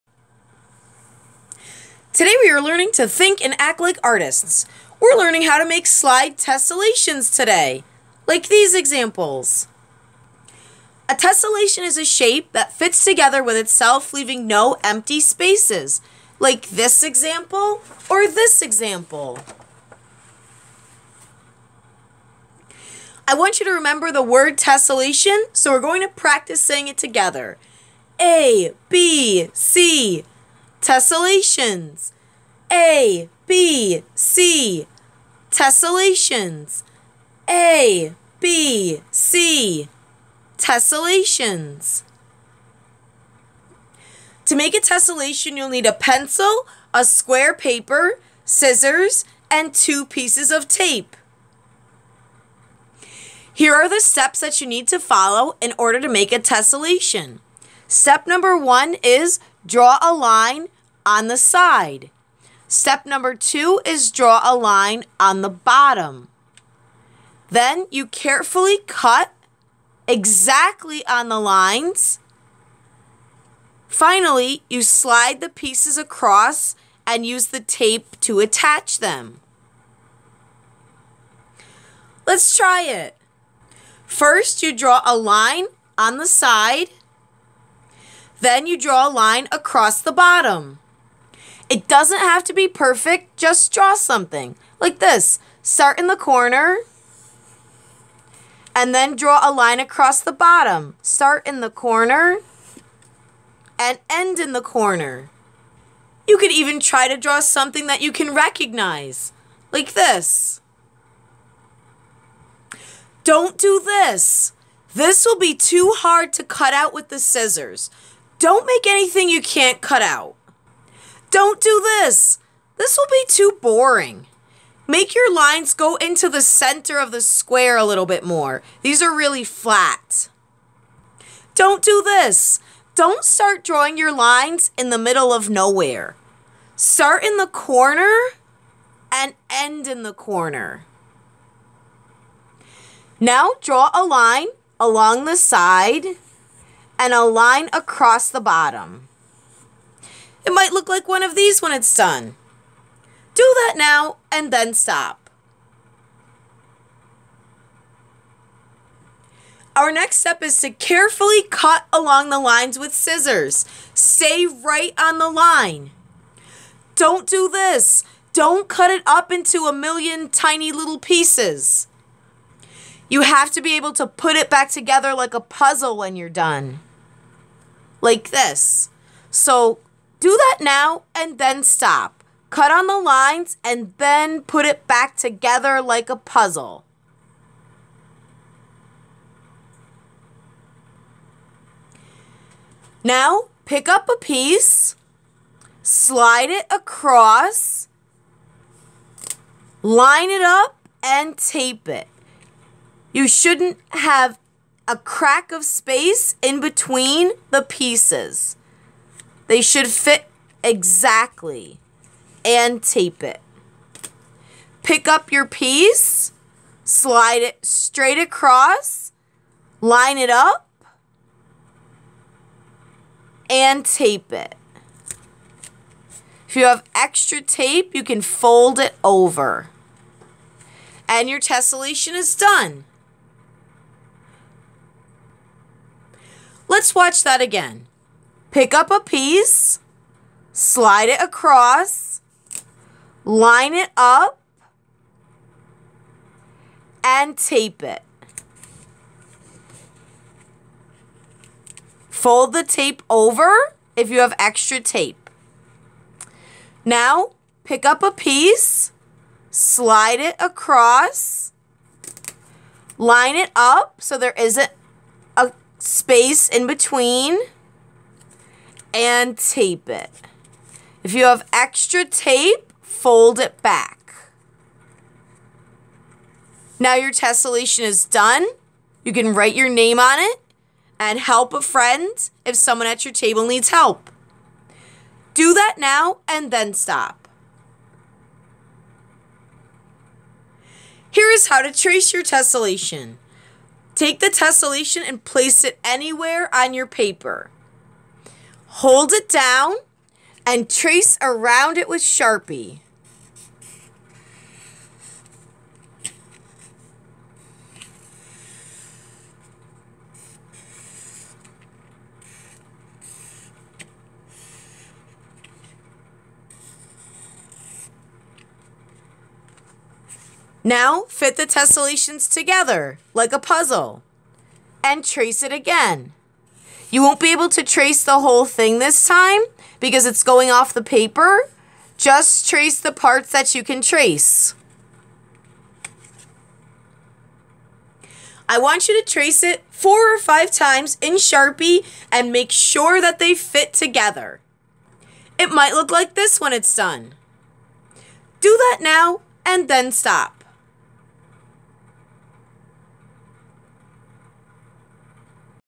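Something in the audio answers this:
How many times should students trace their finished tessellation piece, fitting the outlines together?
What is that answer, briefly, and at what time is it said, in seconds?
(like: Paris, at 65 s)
4 or 5, at 339 s.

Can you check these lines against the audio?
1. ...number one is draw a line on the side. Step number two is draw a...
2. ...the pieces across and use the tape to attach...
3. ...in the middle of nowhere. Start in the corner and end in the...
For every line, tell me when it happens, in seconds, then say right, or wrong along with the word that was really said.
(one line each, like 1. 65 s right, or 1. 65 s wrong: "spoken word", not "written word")
1. 58 s right
2. 75 s right
3. 134 s right.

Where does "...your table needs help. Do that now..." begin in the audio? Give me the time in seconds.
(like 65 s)
283 s.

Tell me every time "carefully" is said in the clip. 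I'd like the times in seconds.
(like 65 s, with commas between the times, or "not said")
68 s, 160 s.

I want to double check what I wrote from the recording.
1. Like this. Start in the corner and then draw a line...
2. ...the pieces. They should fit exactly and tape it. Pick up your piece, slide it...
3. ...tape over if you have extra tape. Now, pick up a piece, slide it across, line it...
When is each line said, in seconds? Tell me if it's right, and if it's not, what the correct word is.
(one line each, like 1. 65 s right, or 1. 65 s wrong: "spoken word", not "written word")
1. 94 s right
2. 207 s right
3. 252 s right.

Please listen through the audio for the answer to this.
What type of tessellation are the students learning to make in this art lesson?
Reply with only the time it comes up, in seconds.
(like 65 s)
5 s.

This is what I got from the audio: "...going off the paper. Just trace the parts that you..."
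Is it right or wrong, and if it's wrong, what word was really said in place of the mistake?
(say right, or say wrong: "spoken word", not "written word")
right.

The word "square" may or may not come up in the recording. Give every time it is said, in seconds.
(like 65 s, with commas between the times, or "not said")
47 s, 127 s.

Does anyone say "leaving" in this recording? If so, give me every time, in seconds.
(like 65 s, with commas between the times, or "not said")
14 s.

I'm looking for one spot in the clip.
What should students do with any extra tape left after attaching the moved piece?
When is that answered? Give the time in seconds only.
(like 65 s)
228 s.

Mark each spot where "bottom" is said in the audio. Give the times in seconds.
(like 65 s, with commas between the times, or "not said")
65 s, 90 s, 100 s, 148 s.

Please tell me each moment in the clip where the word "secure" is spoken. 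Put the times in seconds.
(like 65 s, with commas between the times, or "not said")
not said.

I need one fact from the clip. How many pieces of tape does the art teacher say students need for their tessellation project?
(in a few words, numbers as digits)
2.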